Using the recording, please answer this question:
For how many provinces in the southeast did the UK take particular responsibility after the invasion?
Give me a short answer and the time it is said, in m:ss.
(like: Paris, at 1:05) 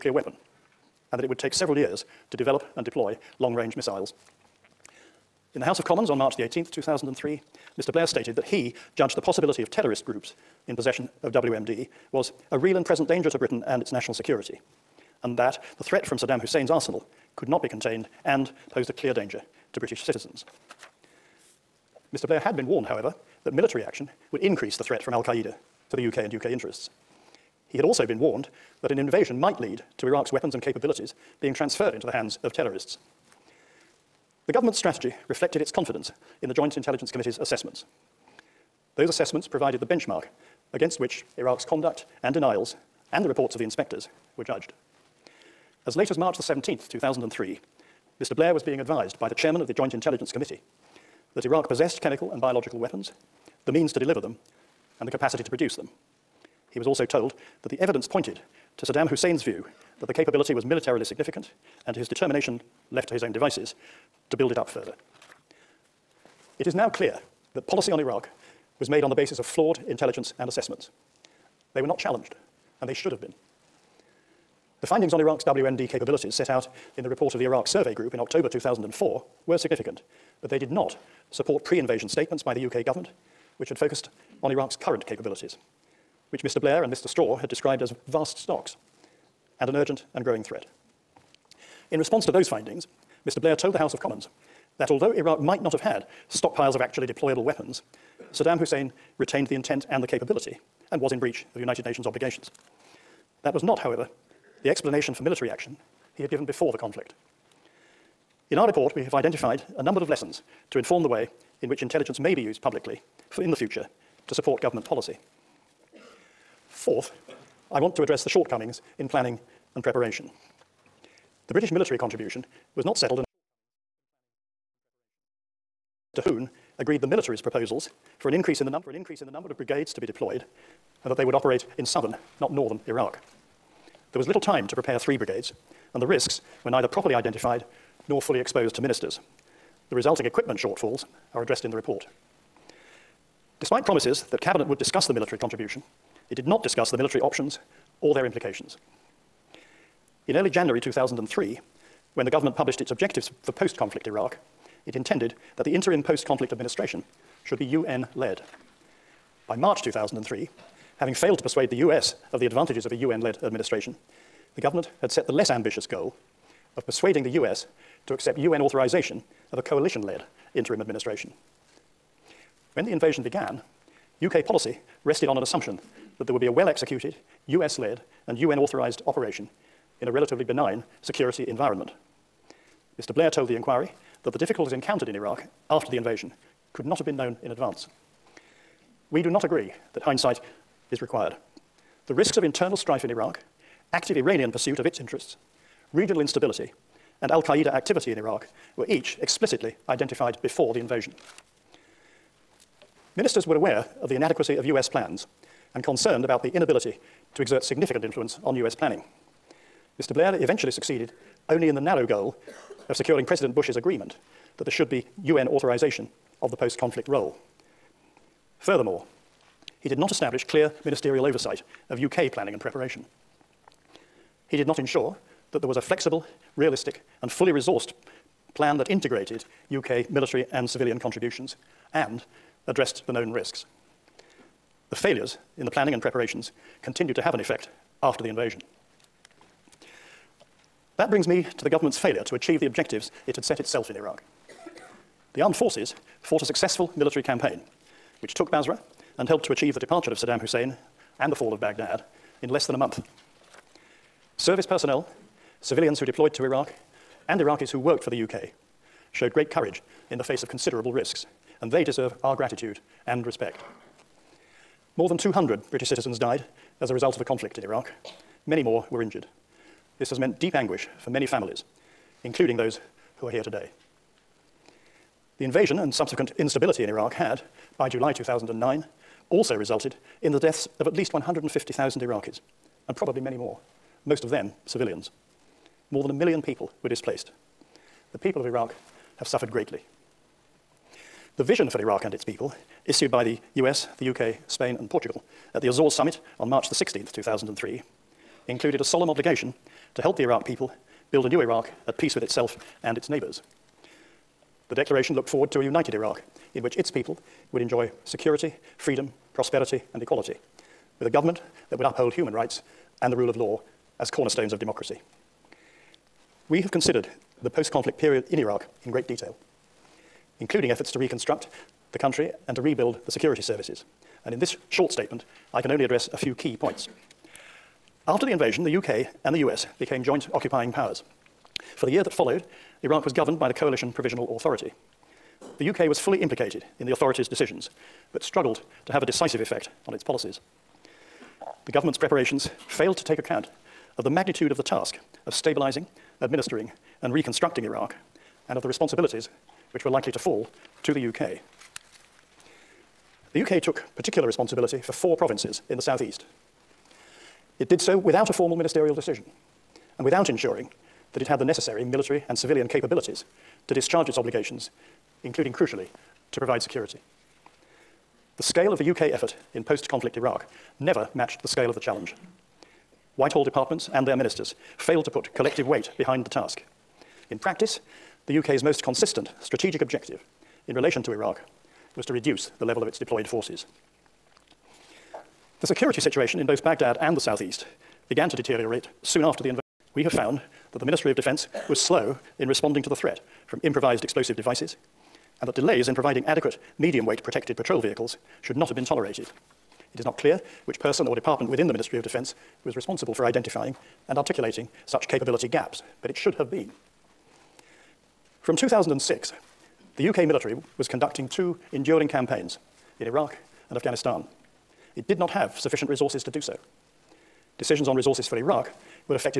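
4, at 5:54.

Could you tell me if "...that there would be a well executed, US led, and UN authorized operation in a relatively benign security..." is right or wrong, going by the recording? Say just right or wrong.
right.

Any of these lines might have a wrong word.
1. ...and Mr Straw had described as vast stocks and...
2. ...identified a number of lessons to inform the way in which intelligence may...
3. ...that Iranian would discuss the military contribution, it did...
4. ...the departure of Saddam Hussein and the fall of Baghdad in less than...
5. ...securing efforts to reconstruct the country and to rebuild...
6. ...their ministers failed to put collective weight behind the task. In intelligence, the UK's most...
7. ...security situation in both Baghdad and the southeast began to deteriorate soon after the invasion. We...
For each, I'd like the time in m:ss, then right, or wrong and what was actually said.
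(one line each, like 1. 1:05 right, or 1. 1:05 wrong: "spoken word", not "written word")
1. 1:26 right
2. 1:49 right
3. 2:24 wrong: "Cabinet", not "Iranian"
4. 4:09 right
5. 5:20 wrong: "including", not "securing"
6. 6:14 wrong: "practice", not "intelligence"
7. 6:25 right.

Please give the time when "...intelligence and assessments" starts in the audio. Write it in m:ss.
1:09.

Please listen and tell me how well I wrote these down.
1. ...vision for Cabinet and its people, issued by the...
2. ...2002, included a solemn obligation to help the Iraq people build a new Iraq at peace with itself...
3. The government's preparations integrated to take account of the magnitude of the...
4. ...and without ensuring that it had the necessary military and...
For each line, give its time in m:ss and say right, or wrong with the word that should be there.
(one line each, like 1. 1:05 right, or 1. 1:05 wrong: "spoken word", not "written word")
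1. 4:51 wrong: "Iraq", not "Cabinet"
2. 4:57 wrong: "2003", not "2002"
3. 5:41 wrong: "failed", not "integrated"
4. 5:59 right.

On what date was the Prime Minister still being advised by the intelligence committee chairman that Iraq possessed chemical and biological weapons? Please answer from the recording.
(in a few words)
March 17, 2003.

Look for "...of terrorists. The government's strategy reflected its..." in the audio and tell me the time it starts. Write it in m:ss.
0:32.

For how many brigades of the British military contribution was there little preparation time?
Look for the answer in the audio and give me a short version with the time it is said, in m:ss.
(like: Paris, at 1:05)
3, at 2:14.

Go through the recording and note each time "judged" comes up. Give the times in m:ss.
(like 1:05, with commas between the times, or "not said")
0:08, 0:44.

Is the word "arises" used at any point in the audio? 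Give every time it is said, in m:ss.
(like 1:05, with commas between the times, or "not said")
not said.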